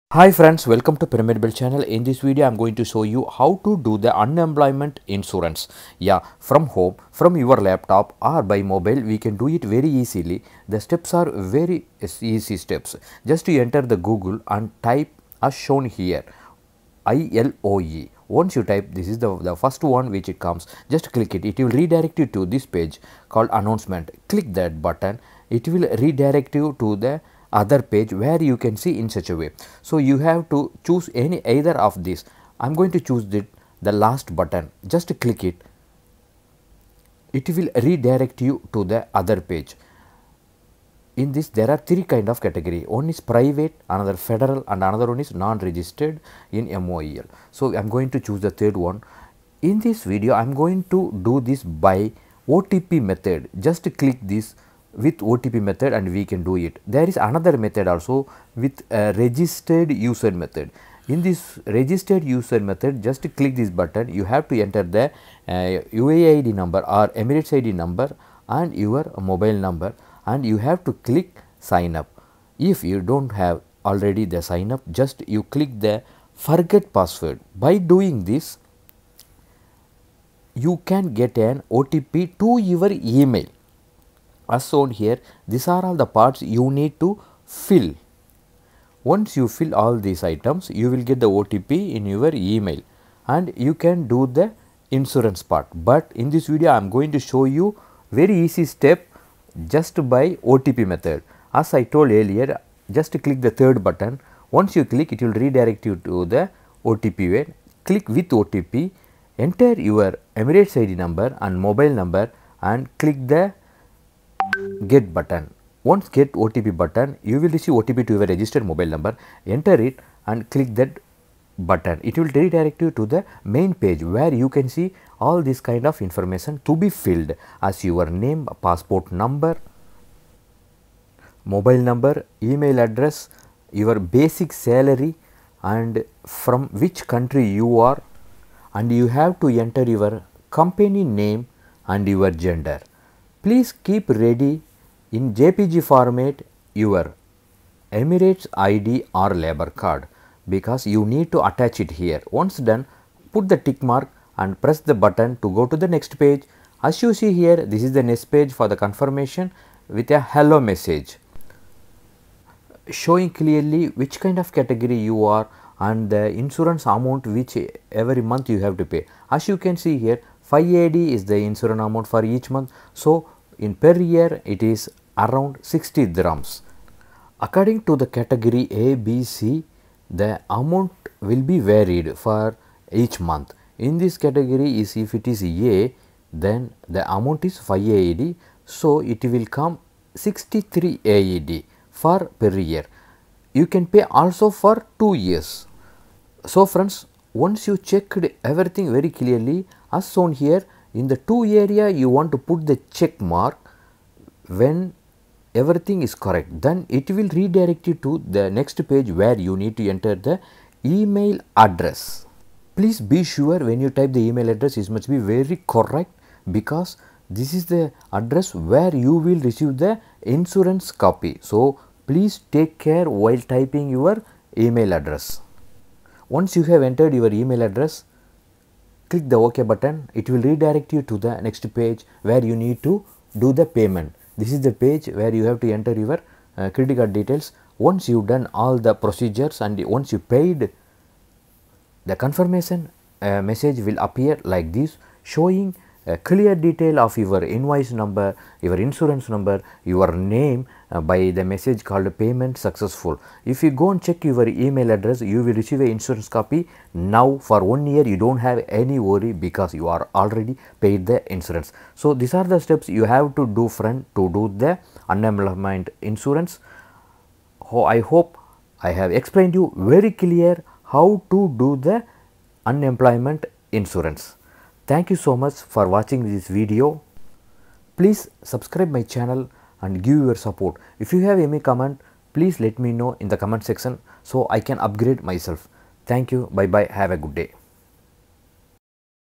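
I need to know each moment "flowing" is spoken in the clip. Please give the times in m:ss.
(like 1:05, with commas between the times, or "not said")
not said.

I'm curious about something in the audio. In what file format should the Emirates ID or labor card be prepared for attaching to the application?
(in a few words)
JPG.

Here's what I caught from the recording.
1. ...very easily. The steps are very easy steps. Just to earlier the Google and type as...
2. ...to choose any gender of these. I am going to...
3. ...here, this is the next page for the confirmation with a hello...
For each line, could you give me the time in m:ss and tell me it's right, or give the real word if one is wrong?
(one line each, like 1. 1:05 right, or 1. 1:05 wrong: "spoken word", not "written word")
1. 0:09 wrong: "enter", not "earlier"
2. 0:30 wrong: "either", not "gender"
3. 2:37 right.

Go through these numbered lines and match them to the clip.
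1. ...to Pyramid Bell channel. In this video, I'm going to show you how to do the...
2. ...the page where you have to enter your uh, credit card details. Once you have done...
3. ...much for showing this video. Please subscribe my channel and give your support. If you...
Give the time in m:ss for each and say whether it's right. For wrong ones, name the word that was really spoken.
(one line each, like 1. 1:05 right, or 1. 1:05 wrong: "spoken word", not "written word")
1. 0:00 right
2. 3:54 right
3. 4:35 wrong: "watching", not "showing".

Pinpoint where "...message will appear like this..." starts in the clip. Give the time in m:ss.
4:03.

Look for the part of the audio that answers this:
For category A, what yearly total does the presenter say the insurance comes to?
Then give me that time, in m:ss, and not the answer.
3:10.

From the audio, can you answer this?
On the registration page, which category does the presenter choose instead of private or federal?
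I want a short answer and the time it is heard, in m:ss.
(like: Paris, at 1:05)
non-registered in MOEL, at 0:45.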